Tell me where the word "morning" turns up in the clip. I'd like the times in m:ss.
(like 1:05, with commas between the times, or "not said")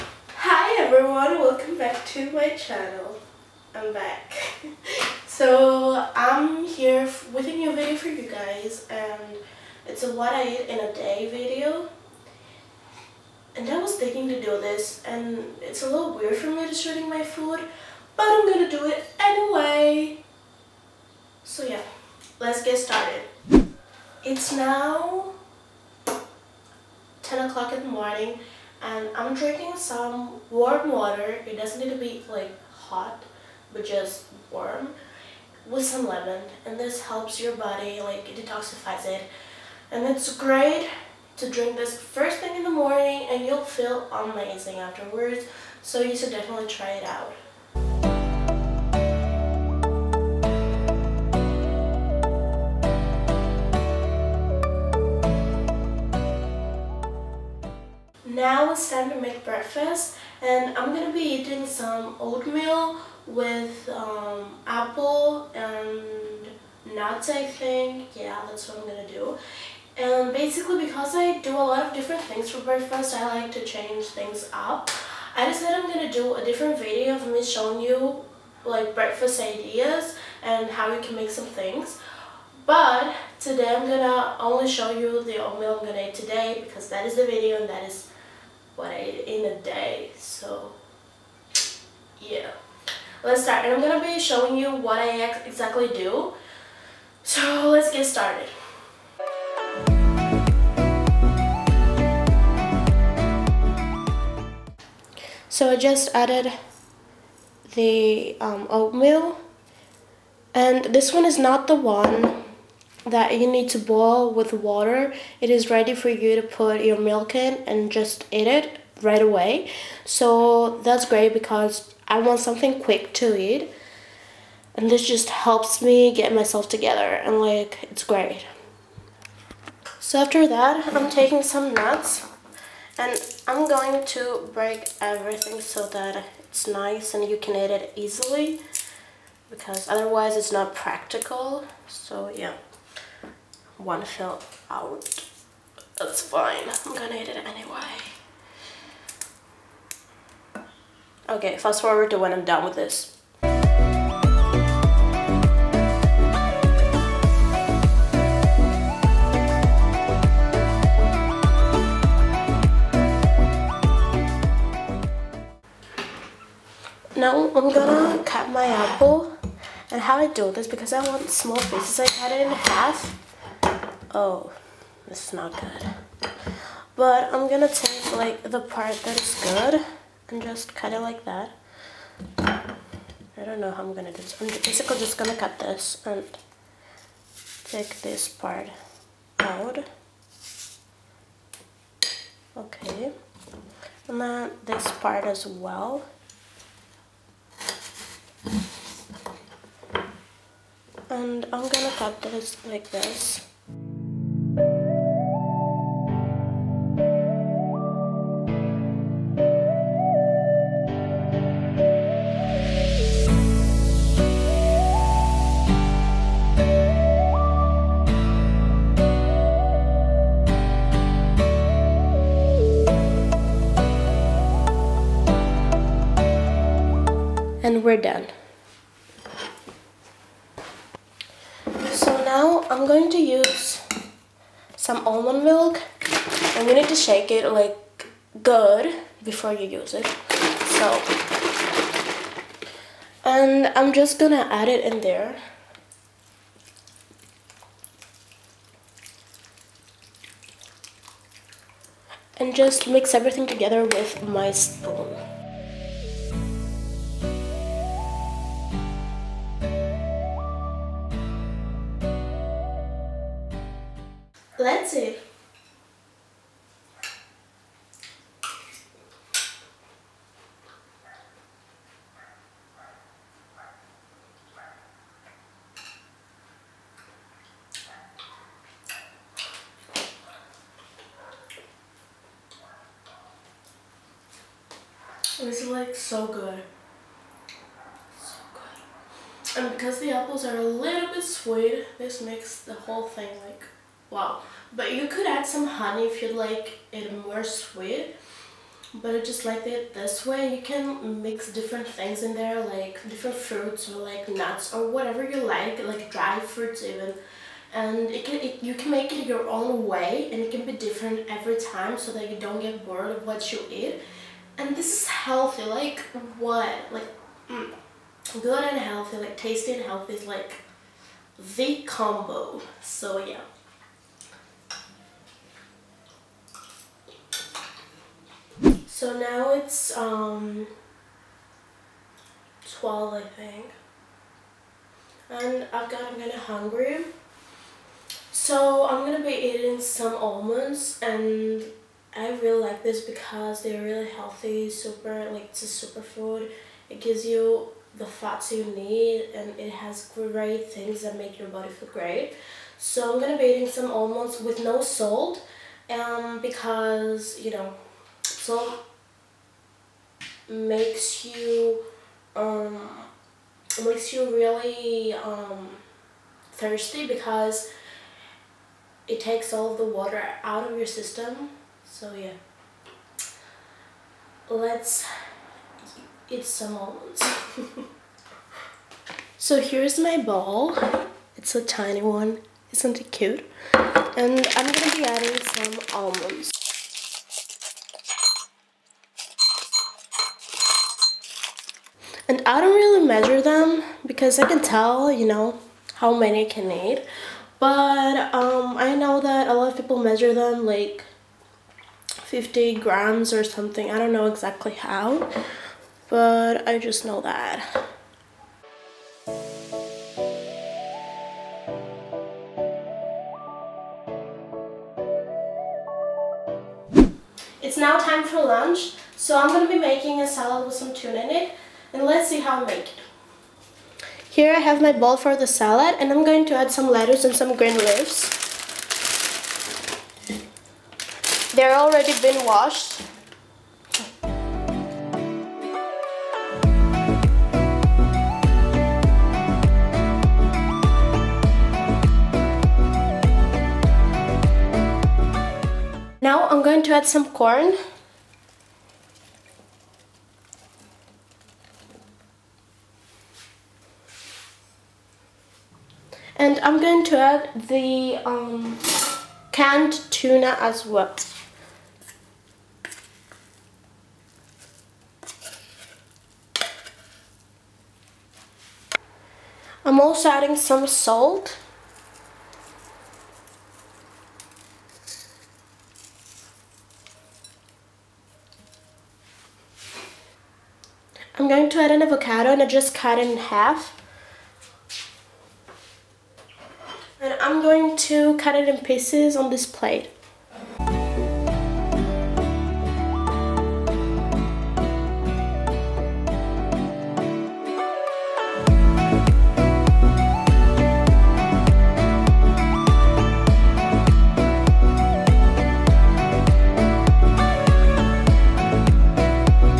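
0:27, 0:42.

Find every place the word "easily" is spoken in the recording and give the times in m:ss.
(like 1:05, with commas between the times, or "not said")
2:17.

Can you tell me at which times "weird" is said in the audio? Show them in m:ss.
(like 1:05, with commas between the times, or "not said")
0:16.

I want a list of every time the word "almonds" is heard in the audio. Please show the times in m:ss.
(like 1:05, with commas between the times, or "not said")
3:55, 5:40, 5:53, 6:16, 6:25.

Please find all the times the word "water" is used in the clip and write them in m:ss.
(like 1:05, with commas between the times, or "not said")
0:30, 1:54, 6:09.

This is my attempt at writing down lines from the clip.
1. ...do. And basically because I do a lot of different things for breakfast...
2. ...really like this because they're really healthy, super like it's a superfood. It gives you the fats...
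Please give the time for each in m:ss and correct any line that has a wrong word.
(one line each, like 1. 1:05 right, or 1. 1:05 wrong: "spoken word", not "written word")
1. 1:09 right
2. 5:42 right.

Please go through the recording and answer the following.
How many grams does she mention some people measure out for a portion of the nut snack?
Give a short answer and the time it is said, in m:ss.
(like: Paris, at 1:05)
50, at 6:42.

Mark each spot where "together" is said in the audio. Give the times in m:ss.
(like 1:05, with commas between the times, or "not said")
2:06, 4:13.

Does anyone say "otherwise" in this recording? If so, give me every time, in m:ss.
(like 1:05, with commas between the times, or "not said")
2:19.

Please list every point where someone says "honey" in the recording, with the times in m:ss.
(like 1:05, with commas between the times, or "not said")
4:55.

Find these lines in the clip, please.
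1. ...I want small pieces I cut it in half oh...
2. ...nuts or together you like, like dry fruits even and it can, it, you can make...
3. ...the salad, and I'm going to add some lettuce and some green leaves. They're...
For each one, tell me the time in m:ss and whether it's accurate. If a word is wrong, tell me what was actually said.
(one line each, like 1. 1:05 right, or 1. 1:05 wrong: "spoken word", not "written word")
1. 2:50 right
2. 5:04 wrong: "whatever", not "together"
3. 7:05 right.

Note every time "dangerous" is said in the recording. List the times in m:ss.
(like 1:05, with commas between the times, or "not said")
not said.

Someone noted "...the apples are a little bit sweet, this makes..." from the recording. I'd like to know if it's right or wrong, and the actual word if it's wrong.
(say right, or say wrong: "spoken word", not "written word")
right.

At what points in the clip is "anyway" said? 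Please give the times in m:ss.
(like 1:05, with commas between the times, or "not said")
0:19, 2:27.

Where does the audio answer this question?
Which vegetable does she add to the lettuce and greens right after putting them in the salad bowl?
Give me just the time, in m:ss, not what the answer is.
7:27.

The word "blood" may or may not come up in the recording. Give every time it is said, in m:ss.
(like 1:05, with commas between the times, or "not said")
not said.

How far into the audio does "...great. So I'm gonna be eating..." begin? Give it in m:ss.
5:51.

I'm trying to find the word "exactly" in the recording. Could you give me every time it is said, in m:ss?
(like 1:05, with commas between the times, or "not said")
1:35, 6:44.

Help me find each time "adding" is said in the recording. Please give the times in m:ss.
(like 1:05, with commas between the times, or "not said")
6:25, 7:50.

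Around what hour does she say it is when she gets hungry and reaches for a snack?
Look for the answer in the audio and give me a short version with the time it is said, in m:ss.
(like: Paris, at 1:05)
12, at 5:32.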